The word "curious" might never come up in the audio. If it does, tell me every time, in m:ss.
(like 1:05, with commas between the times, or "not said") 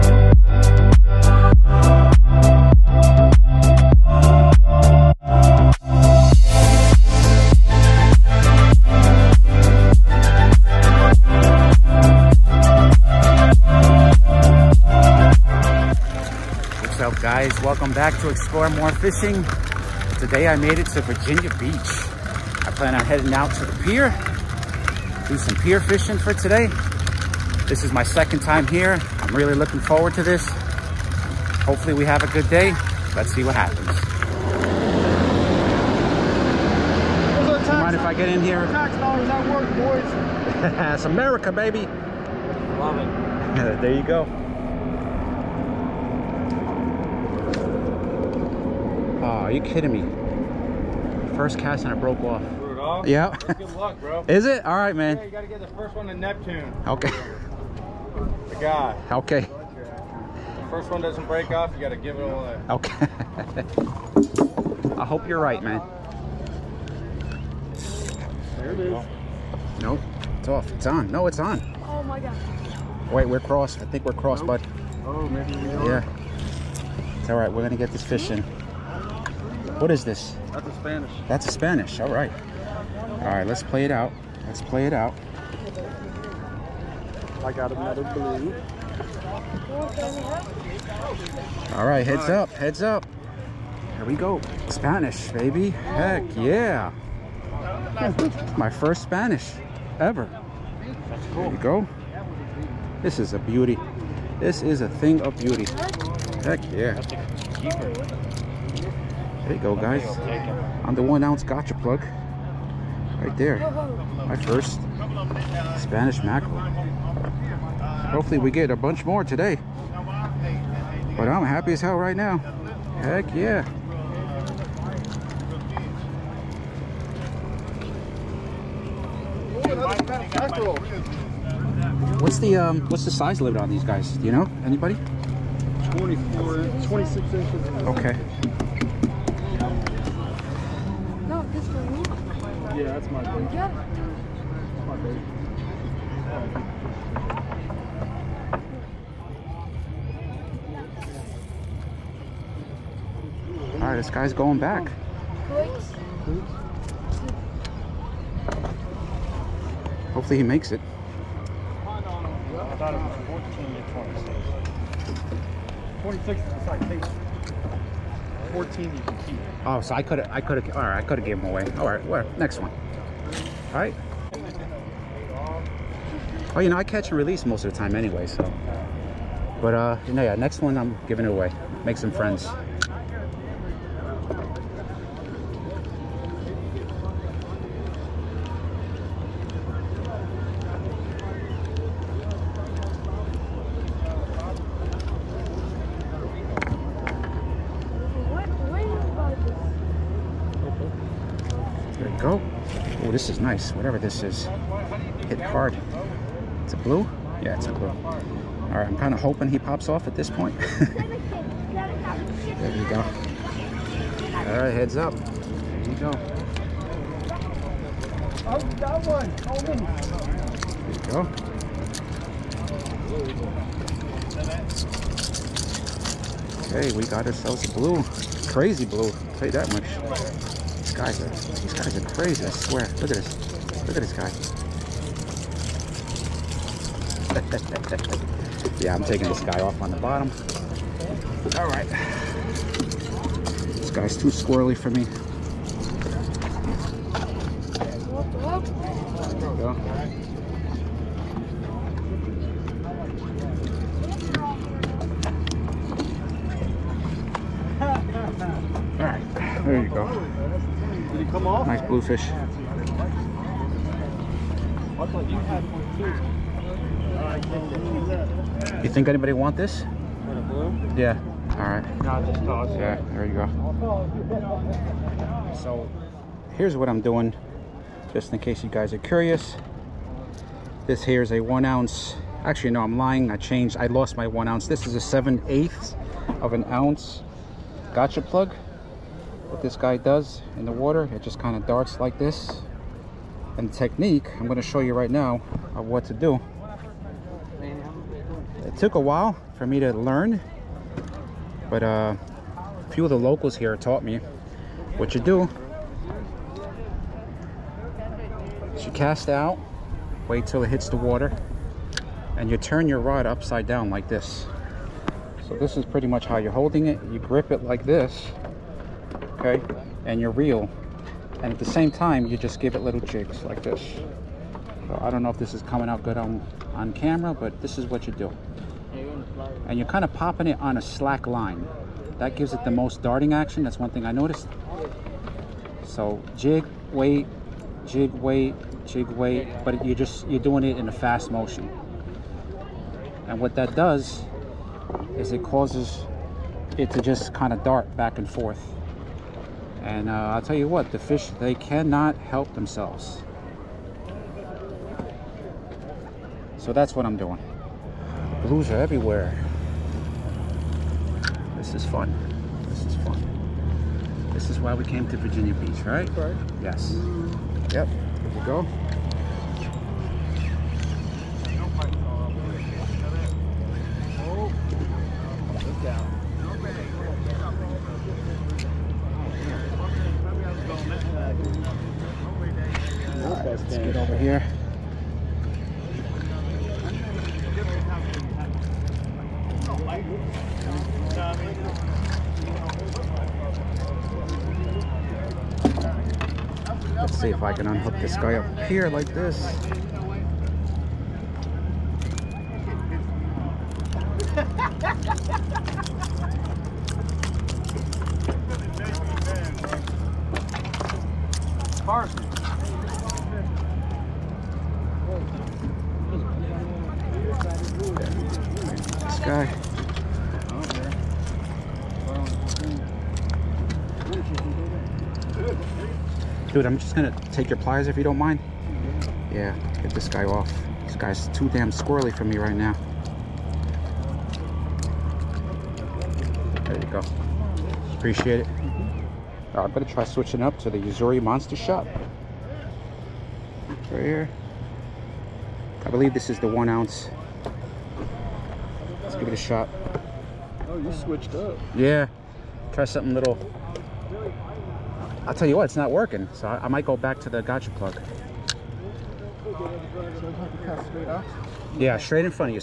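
4:38.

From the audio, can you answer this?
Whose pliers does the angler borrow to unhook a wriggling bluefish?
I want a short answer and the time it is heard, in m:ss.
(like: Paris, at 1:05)
Carson, at 6:51.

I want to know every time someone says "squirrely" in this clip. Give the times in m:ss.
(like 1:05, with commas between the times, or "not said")
4:04, 7:11.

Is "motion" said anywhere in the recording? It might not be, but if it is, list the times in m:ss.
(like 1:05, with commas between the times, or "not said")
5:41.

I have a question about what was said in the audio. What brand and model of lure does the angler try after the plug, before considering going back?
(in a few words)
Yozuri Monster Shot.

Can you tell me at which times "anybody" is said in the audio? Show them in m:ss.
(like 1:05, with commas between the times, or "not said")
2:14, 4:29.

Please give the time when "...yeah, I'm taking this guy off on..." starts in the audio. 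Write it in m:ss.
3:58.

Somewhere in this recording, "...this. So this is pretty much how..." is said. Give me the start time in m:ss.
5:14.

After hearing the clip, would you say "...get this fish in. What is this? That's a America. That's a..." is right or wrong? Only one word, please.
wrong.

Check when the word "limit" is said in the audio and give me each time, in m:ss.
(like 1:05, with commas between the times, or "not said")
2:13.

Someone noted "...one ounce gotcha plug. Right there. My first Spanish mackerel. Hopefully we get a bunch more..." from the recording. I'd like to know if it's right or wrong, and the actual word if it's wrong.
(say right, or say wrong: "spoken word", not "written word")
right.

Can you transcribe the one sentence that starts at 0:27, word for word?
This is my second time here.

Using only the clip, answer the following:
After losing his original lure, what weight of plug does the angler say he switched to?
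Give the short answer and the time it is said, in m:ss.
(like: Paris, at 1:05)
7/8 ounce, at 4:45.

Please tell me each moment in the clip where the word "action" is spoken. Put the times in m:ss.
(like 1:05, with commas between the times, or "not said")
5:33.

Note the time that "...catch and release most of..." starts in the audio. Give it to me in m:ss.
2:56.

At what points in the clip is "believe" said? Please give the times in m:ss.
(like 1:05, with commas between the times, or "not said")
7:25.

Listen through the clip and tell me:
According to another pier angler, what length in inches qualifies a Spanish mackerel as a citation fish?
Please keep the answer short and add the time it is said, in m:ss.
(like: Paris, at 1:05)
26, at 2:46.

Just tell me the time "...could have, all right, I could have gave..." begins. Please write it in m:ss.
2:50.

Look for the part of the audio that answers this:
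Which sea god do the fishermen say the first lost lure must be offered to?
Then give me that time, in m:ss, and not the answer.
0:56.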